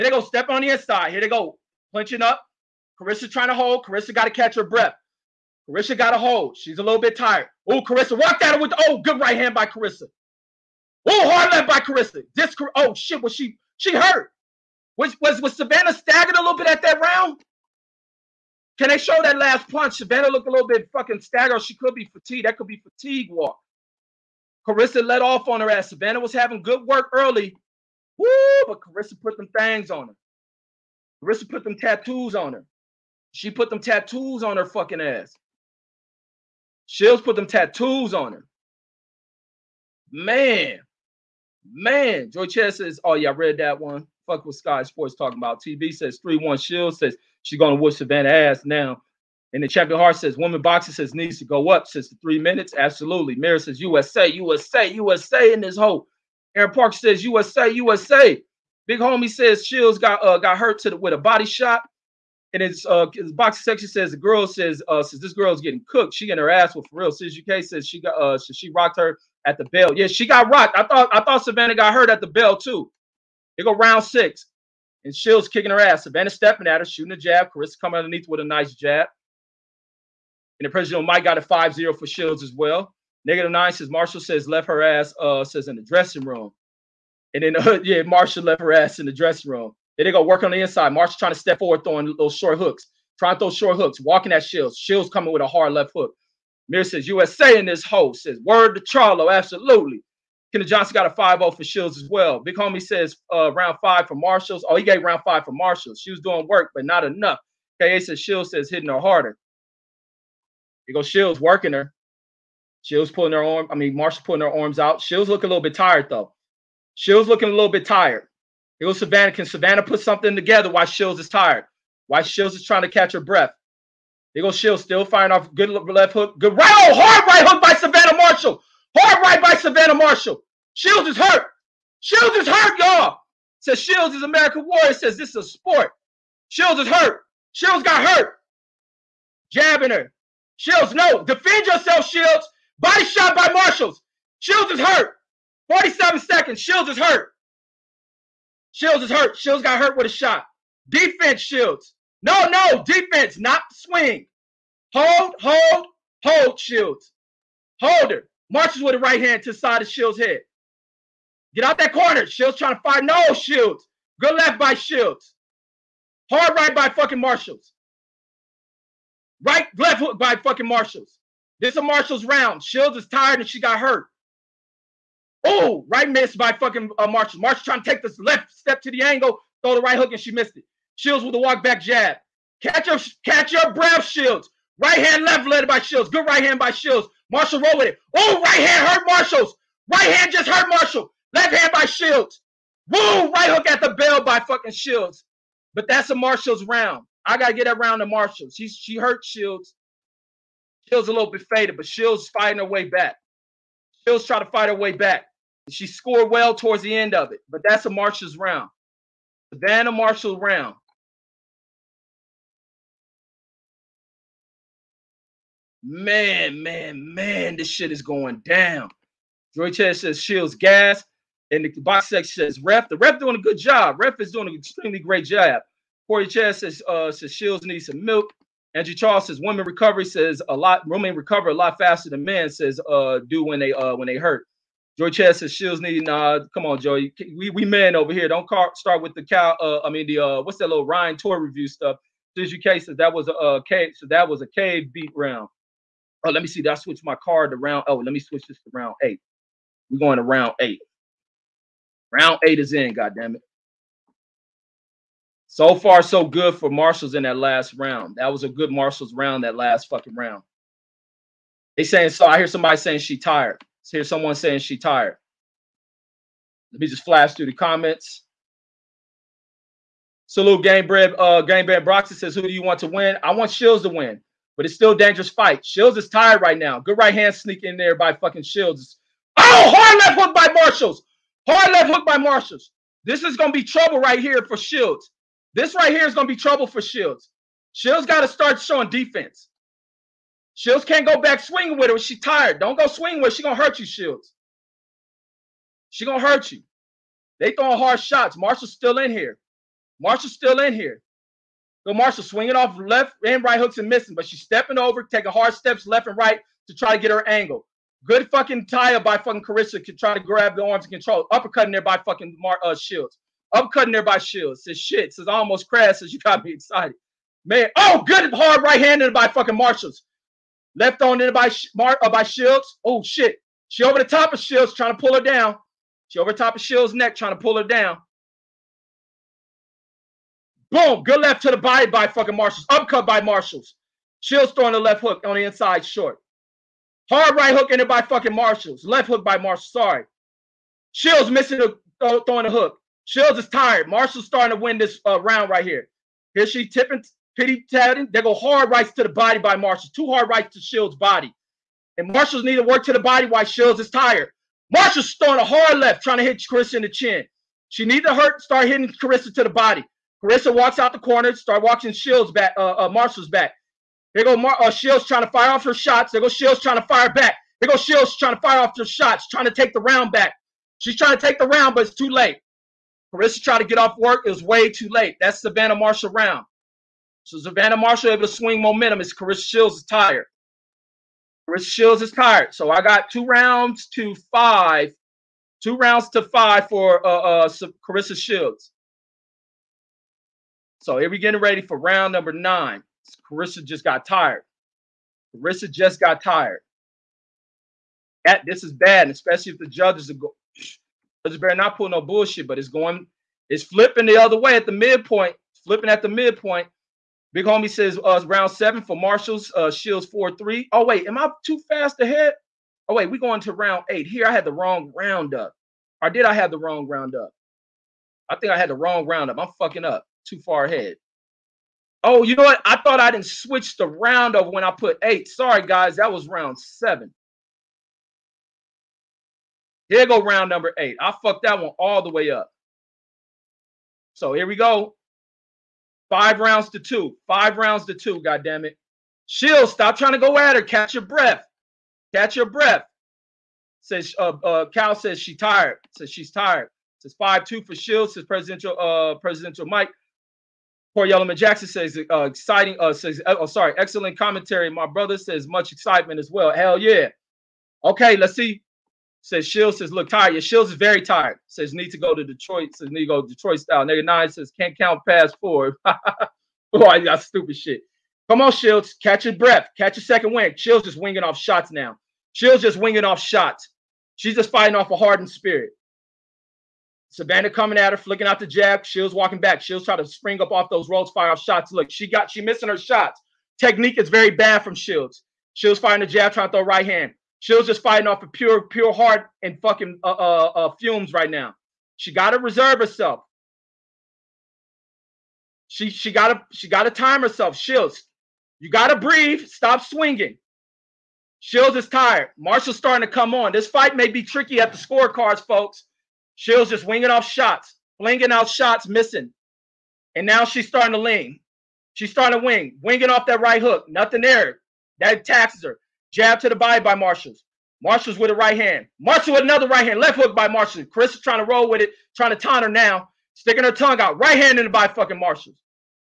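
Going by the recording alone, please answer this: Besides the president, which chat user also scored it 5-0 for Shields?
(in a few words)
Kenneth Johnson.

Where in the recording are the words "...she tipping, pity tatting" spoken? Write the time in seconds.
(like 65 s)
346 s.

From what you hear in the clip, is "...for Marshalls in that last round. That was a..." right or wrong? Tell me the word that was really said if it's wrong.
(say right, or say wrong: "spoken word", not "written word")
right.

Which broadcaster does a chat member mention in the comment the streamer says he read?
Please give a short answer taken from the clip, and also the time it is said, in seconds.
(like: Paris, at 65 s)
Sky Sports, at 44 s.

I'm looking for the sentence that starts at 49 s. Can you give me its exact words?
And the champion heart says, woman boxing says needs to go up since the three minutes.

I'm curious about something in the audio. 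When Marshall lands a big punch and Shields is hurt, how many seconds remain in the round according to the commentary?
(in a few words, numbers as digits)
47.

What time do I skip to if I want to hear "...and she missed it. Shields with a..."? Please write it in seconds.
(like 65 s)
180 s.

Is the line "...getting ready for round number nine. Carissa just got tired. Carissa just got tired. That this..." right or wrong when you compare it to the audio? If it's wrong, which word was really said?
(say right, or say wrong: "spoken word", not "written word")
right.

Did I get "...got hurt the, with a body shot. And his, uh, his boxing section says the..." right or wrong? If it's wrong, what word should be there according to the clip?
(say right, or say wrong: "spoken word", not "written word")
right.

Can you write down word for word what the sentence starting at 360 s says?
Carissa walks out the corner, start watching Shields back, uh, uh, Marshall's back.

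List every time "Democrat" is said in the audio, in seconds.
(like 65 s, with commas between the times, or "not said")
not said.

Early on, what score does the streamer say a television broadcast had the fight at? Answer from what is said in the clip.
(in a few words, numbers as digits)
3-1.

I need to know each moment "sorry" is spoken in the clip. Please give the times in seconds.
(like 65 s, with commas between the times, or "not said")
339 s, 425 s, 453 s.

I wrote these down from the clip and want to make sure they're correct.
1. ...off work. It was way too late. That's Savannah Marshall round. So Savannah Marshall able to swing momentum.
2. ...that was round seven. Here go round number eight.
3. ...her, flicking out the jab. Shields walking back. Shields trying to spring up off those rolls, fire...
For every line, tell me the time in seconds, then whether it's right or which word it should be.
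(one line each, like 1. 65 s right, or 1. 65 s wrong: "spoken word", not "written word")
1. 373 s right
2. 425 s right
3. 477 s right.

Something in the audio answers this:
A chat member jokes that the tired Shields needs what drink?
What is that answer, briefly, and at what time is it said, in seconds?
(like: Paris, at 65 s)
milk, at 228 s.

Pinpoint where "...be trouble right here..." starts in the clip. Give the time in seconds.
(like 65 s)
283 s.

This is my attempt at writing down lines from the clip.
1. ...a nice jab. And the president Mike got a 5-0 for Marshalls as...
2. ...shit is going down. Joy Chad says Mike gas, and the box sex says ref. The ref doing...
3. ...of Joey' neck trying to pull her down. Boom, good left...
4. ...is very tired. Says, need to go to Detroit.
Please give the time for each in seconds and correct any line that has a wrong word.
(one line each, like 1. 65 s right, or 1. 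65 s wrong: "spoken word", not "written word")
1. 78 s wrong: "Shields", not "Marshalls"
2. 217 s wrong: "Shields", not "Mike"
3. 326 s wrong: "Shields", not "Joey"
4. 460 s right.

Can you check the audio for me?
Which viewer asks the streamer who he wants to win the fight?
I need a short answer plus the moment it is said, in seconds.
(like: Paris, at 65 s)
Game Bread Broxton, at 271 s.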